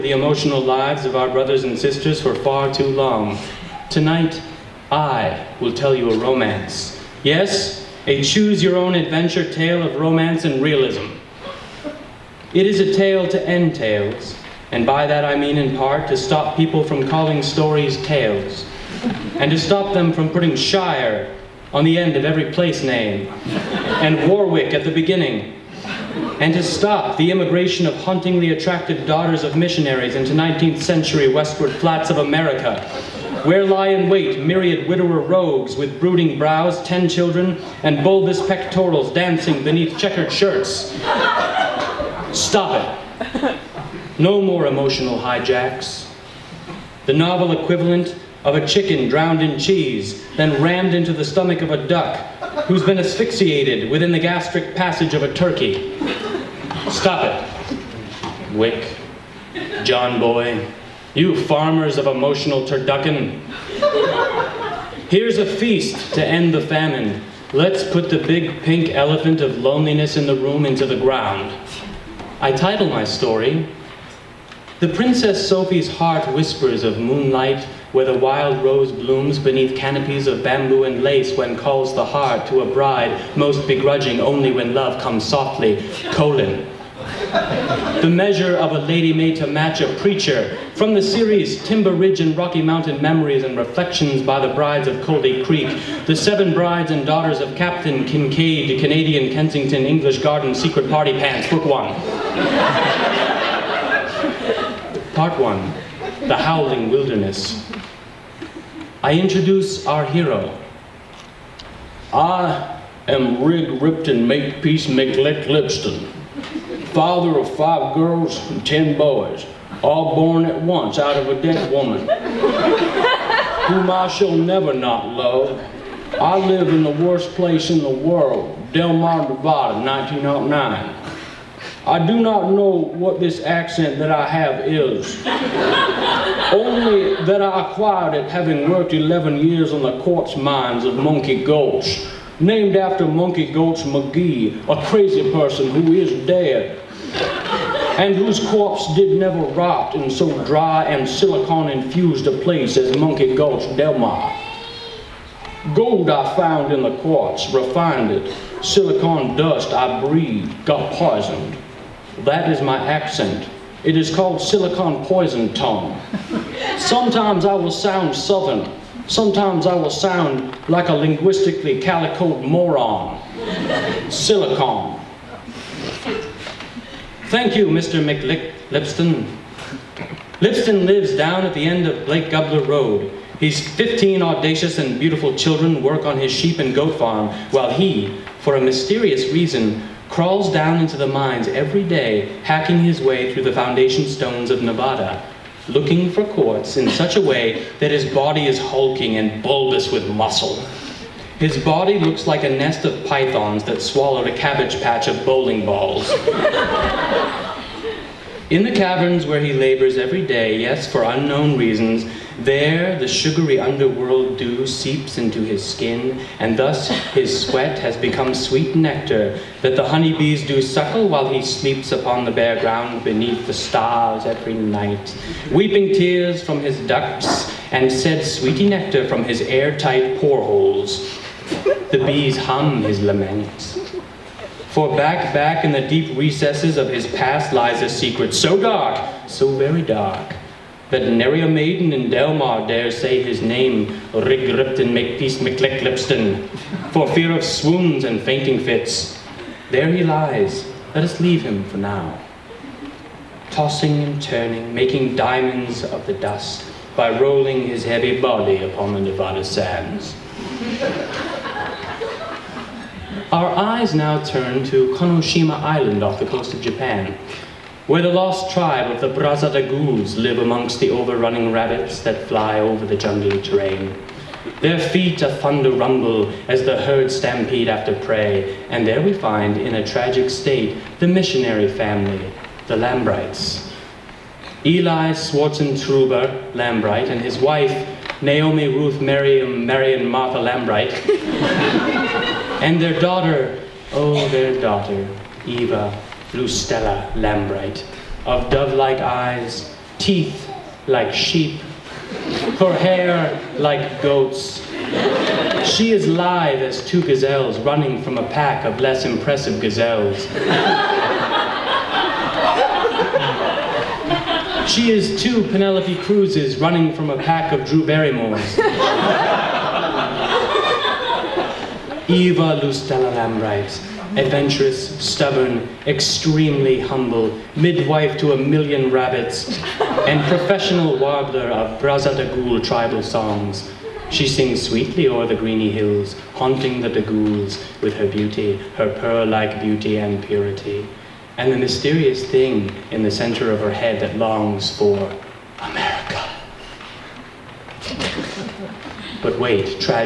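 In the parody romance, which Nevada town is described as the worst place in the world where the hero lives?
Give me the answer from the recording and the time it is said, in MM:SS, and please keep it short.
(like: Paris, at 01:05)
Del Mar, at 02:08.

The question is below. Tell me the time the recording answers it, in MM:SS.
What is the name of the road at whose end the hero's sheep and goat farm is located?
03:02.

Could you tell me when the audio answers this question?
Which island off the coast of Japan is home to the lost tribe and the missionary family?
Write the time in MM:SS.
04:24.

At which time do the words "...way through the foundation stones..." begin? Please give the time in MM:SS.
03:12.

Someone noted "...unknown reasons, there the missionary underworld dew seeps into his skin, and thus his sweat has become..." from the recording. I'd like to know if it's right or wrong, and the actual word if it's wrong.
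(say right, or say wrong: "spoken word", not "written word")
wrong: "sugary", not "missionary".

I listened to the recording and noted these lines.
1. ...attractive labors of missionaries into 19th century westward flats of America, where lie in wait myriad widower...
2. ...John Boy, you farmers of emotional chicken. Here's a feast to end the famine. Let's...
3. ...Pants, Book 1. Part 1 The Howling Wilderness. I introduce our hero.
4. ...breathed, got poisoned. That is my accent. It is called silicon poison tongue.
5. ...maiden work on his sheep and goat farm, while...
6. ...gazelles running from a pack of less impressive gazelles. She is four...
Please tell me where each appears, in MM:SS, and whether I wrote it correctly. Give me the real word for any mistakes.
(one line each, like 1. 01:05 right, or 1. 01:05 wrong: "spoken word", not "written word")
1. 00:28 wrong: "daughters", not "labors"
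2. 00:59 wrong: "turducken", not "chicken"
3. 01:41 right
4. 02:40 right
5. 03:05 wrong: "children", not "maiden"
6. 05:07 wrong: "two", not "four".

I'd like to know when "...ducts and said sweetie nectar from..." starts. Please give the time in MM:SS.
03:46.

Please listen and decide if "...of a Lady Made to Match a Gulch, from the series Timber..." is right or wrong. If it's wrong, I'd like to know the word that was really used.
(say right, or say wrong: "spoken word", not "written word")
wrong: "Preacher", not "Gulch".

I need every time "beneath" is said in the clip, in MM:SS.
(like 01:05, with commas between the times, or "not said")
00:39, 01:19, 03:43.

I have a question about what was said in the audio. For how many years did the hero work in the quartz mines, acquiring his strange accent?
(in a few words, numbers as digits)
11.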